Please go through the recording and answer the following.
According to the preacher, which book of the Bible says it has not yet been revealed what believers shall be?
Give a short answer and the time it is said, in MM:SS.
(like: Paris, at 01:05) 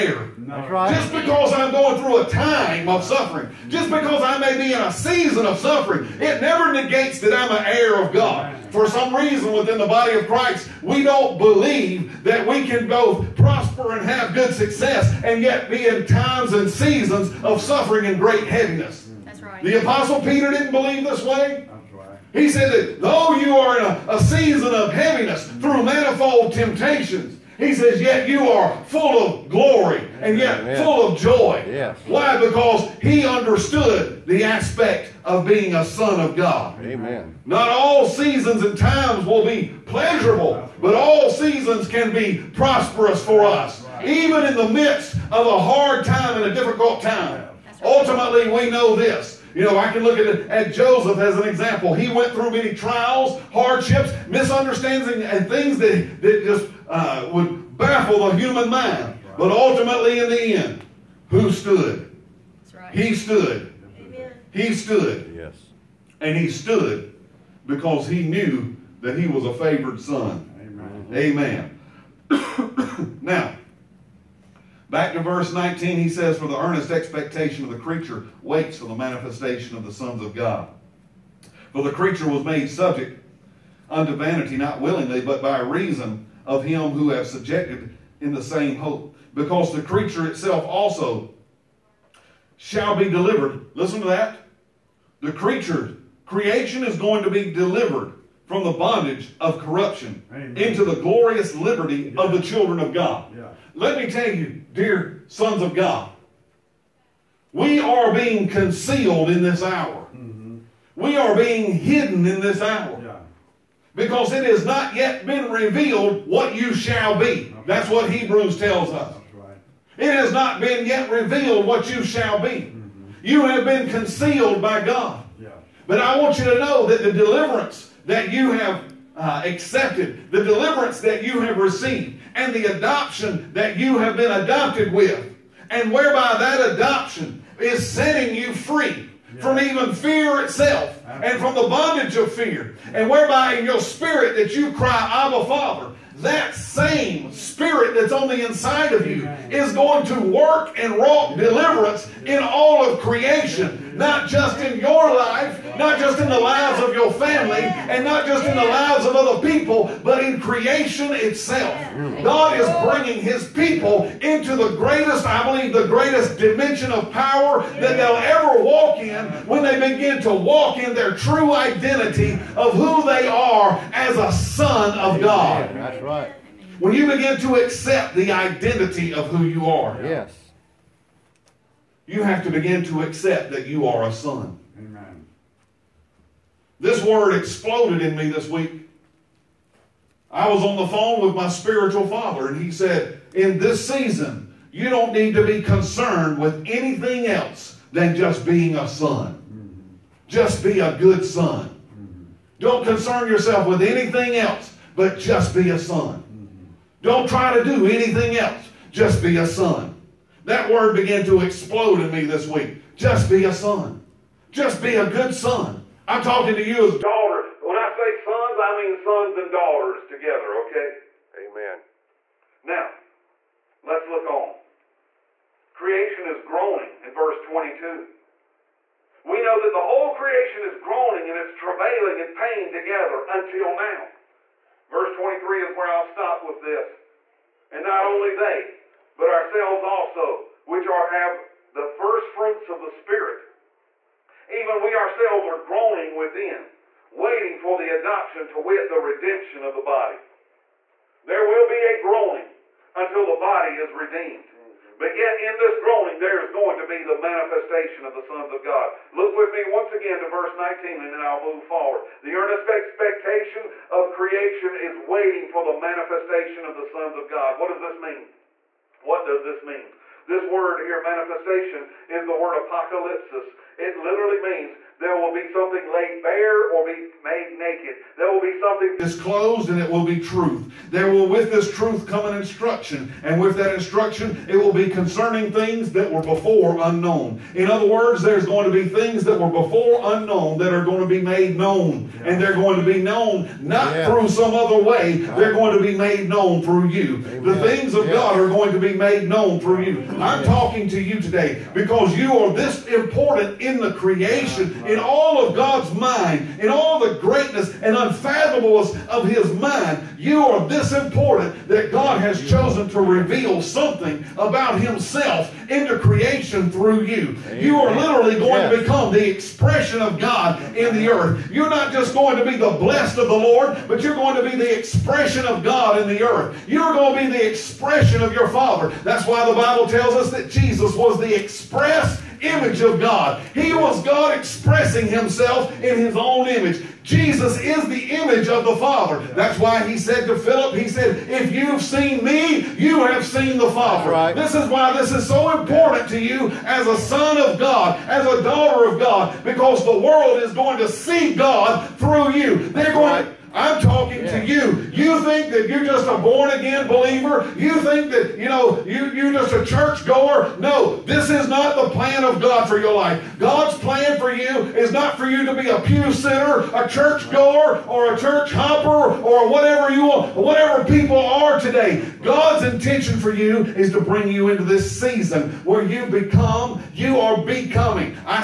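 Hebrews, at 01:58.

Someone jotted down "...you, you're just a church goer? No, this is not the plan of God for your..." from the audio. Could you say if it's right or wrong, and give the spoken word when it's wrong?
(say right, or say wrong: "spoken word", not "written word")
right.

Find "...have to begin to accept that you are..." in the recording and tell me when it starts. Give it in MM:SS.
03:02.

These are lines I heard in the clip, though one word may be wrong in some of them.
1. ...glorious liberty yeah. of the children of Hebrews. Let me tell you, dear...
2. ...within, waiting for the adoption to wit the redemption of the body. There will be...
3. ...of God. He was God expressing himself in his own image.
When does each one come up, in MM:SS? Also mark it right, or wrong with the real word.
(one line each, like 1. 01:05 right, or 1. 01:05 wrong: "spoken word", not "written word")
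1. 01:40 wrong: "God", not "Hebrews"
2. 04:06 right
3. 05:32 right.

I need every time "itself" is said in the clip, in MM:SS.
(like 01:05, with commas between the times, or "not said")
01:30, 02:20, 02:41.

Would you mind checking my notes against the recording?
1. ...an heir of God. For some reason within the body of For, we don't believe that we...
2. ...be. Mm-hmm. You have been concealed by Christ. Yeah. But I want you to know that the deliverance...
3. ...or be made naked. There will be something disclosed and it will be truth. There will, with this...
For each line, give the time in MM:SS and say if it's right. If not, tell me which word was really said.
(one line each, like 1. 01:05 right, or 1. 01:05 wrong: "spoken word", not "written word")
1. 00:07 wrong: "Christ", not "For"
2. 02:02 wrong: "God", not "Christ"
3. 04:36 right.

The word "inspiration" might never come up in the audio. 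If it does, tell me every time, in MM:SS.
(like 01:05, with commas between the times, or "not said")
not said.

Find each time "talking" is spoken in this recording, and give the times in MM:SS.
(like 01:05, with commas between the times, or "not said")
03:36, 05:00, 05:53.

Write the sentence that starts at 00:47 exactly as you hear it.
Ultimately, we know this you know, I can look at, at Joseph as an example.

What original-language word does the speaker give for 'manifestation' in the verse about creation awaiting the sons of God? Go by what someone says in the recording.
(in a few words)
apocalypsis.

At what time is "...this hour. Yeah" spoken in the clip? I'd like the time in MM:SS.
01:52.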